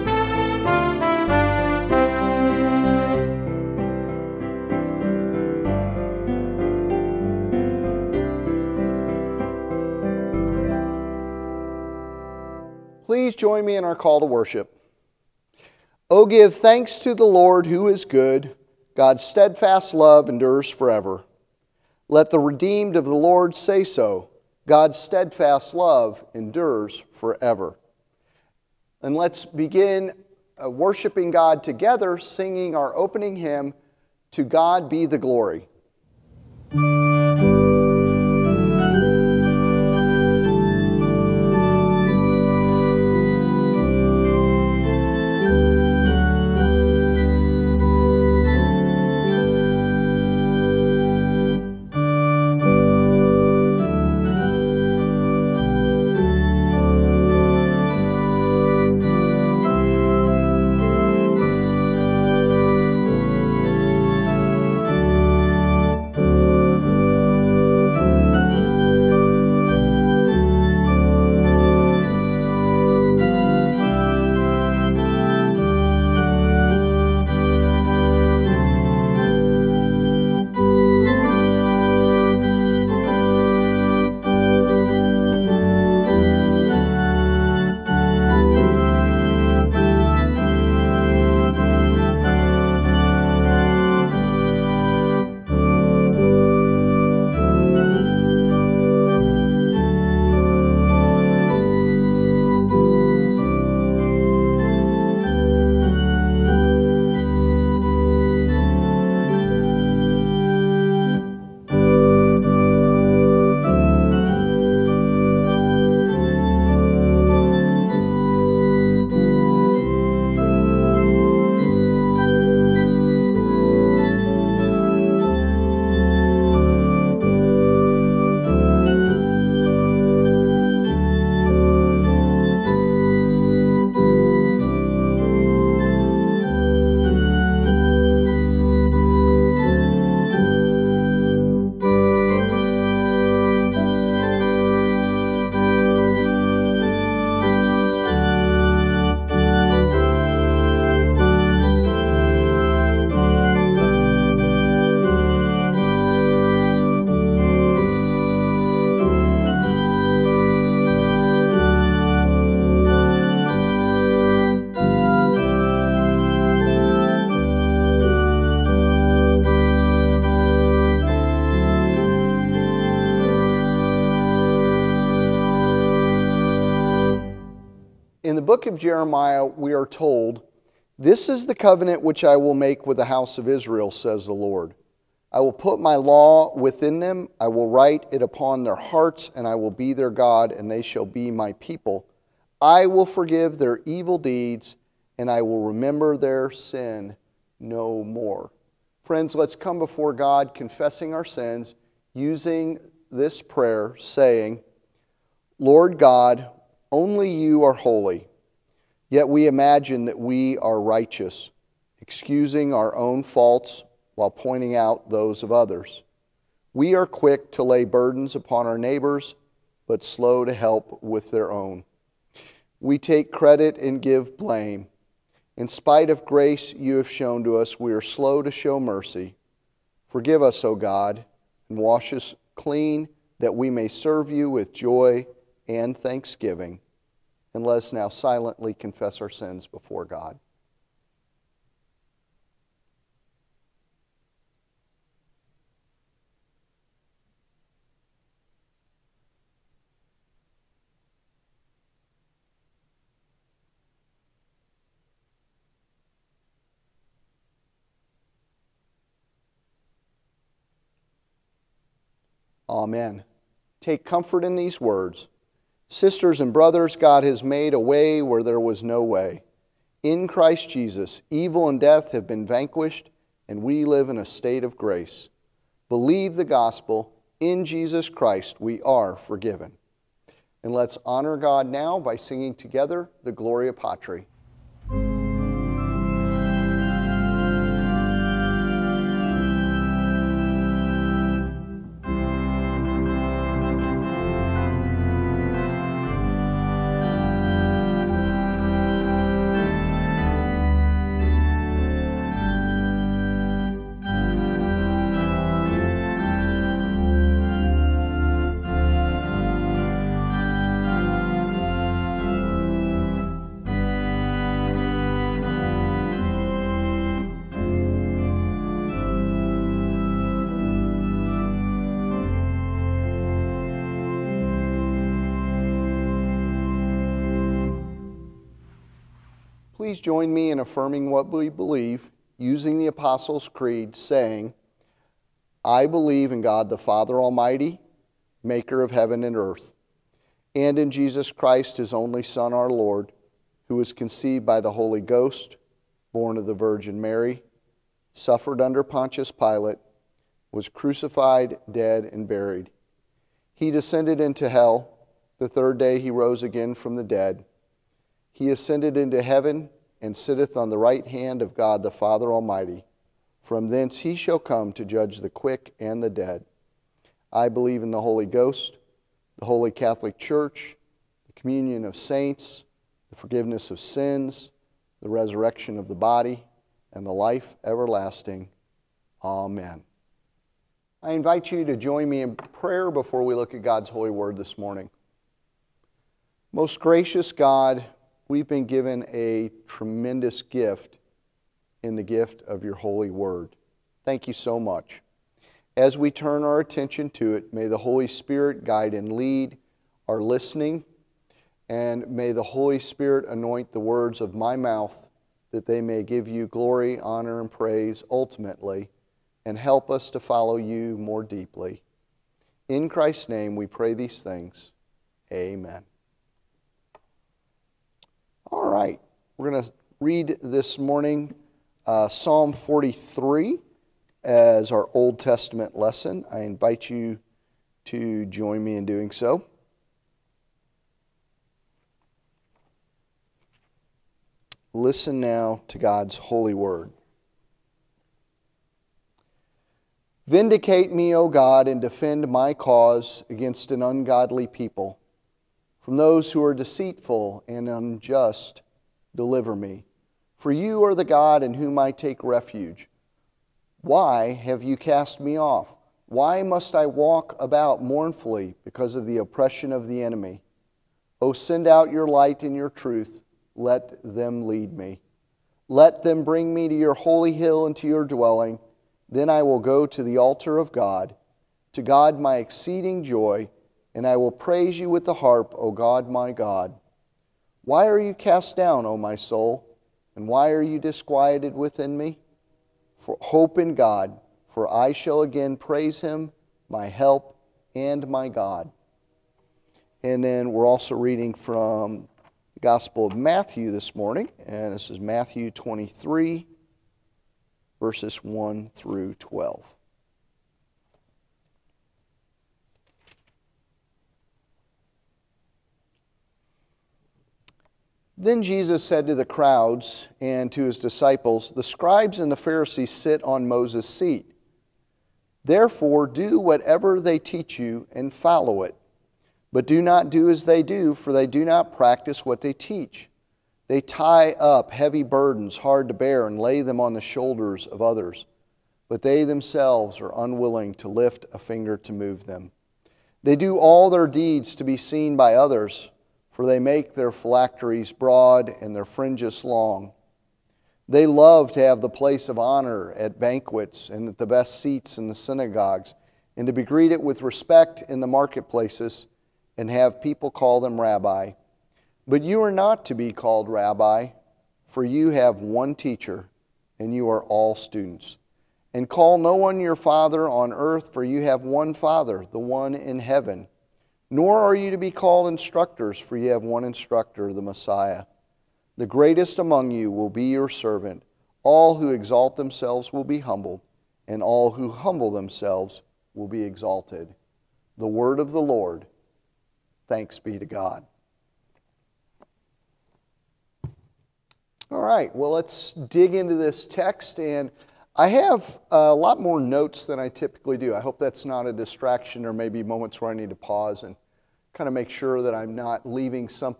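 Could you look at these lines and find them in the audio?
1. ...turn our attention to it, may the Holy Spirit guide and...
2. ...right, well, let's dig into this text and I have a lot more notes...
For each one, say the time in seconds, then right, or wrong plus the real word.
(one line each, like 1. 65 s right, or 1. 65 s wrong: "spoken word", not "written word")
1. 396 s right
2. 584 s right.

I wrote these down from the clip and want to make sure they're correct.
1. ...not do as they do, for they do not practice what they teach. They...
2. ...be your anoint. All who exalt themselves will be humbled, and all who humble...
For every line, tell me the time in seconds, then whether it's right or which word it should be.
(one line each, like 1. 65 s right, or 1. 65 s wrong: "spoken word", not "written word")
1. 519 s right
2. 570 s wrong: "servant", not "anoint".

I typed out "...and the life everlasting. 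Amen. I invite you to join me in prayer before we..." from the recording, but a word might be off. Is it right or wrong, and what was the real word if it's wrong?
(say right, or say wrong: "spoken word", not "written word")
right.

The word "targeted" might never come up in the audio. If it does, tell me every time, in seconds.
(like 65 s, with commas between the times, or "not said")
not said.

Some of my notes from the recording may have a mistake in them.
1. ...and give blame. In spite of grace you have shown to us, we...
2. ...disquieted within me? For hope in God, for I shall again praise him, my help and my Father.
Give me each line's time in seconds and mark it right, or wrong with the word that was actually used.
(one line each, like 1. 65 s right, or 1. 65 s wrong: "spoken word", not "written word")
1. 223 s right
2. 480 s wrong: "God", not "Father".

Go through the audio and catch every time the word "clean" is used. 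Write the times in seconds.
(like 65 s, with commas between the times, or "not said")
232 s.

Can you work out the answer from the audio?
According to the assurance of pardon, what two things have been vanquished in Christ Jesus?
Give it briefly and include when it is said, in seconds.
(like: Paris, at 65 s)
evil and death, at 271 s.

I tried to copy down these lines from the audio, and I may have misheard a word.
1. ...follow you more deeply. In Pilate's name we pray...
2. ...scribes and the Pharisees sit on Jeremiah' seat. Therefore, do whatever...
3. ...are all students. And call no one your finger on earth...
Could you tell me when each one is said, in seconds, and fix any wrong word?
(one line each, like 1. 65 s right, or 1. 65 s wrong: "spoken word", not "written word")
1. 410 s wrong: "Christ", not "Pilate"
2. 511 s wrong: "Moses", not "Jeremiah"
3. 557 s wrong: "father", not "finger".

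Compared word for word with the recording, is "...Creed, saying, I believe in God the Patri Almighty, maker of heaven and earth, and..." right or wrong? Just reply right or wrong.
wrong.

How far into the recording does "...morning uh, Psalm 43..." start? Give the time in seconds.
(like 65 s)
420 s.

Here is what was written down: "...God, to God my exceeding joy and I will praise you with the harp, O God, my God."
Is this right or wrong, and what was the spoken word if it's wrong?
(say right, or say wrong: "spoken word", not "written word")
right.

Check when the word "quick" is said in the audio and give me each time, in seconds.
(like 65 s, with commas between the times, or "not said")
217 s, 365 s.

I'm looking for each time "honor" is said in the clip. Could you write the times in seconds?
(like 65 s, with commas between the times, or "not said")
281 s, 407 s, 542 s.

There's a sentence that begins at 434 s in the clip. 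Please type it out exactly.
Listen now to God's holy word.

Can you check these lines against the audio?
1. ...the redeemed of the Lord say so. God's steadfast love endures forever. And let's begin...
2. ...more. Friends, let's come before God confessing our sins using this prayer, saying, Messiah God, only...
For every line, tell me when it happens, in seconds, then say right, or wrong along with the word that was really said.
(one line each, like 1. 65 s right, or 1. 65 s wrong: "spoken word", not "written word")
1. 22 s right
2. 198 s wrong: "Lord", not "Messiah".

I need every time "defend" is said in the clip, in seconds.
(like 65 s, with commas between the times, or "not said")
441 s.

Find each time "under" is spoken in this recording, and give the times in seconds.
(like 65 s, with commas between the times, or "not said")
348 s.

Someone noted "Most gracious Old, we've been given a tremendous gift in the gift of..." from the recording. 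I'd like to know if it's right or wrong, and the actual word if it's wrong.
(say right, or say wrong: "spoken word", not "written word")
wrong: "God", not "Old".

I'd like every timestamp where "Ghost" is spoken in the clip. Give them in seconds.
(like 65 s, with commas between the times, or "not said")
344 s, 368 s.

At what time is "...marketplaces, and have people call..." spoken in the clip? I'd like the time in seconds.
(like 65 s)
548 s.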